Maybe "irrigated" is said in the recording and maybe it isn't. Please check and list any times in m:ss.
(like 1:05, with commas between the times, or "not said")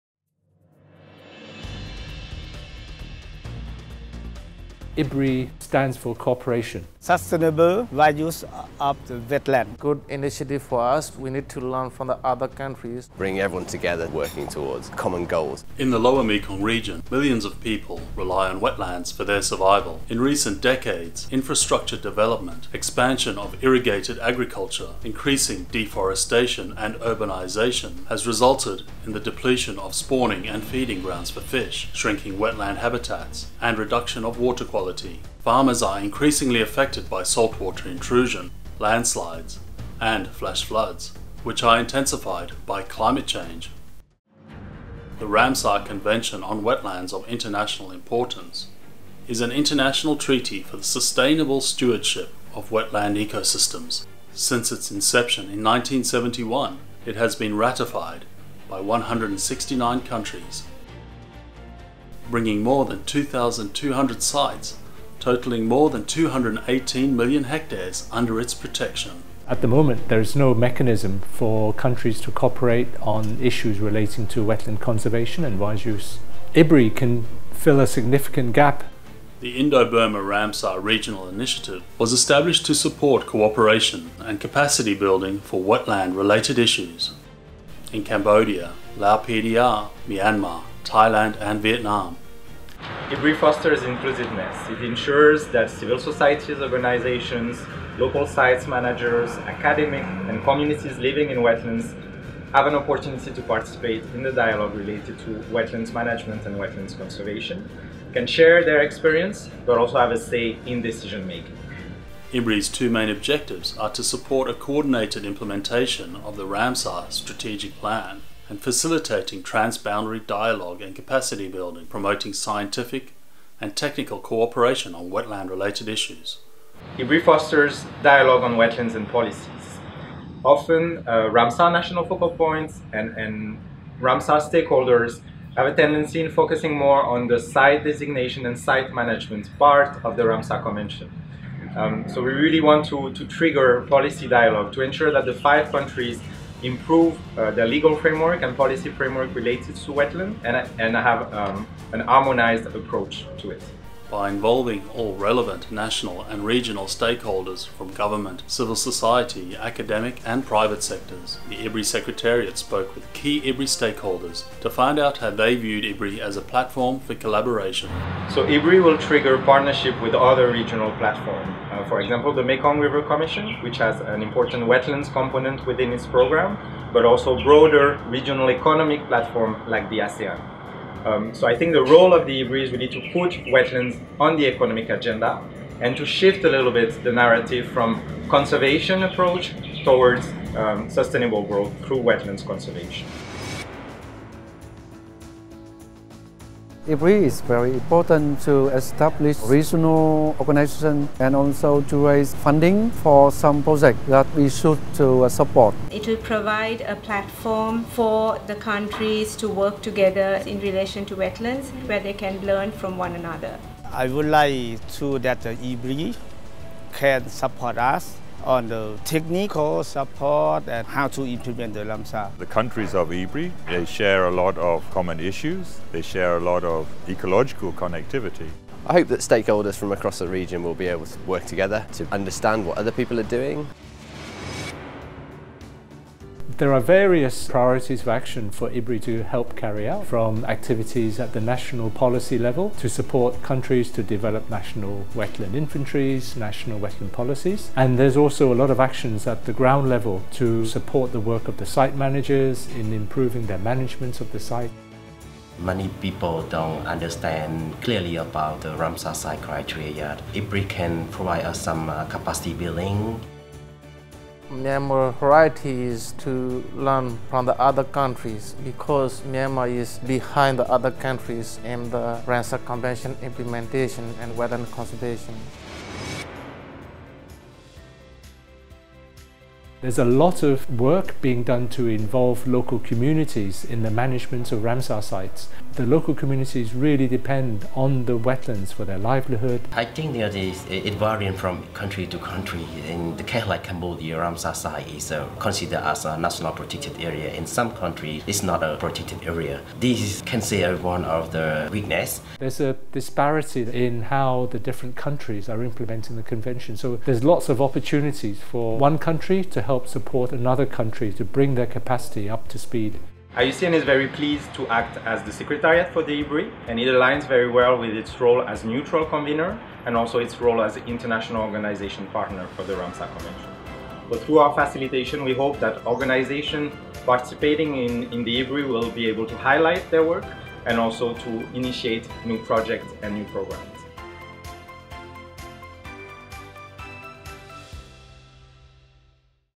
0:23.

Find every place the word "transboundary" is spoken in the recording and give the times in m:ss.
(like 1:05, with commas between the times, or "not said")
1:59.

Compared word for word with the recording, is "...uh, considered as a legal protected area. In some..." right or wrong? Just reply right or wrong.
wrong.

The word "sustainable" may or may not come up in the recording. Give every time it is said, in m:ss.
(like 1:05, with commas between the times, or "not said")
0:06, 0:50, 3:10.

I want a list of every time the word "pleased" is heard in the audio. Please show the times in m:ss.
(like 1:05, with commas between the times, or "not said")
5:14.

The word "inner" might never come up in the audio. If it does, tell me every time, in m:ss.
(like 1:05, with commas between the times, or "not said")
not said.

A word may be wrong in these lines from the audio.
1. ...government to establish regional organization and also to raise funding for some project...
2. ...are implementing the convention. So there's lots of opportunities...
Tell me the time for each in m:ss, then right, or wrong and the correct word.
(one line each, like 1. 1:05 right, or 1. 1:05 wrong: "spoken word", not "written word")
1. 3:17 wrong: "important", not "government"
2. 5:05 right.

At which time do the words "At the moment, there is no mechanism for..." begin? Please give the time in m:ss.
1:09.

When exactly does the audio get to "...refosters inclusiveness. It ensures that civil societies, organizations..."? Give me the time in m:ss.
1:33.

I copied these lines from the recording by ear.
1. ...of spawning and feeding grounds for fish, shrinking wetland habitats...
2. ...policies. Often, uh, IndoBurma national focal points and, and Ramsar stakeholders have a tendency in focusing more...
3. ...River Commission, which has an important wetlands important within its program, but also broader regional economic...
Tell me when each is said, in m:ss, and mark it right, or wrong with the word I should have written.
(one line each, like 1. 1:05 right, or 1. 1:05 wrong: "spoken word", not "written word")
1. 0:29 right
2. 2:09 wrong: "Ramsar", not "IndoBurma"
3. 2:52 wrong: "component", not "important".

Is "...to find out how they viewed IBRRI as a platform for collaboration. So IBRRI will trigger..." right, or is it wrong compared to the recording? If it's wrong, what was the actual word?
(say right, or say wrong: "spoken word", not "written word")
right.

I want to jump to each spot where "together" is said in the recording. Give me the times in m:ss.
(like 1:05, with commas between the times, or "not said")
0:13, 3:29, 3:51.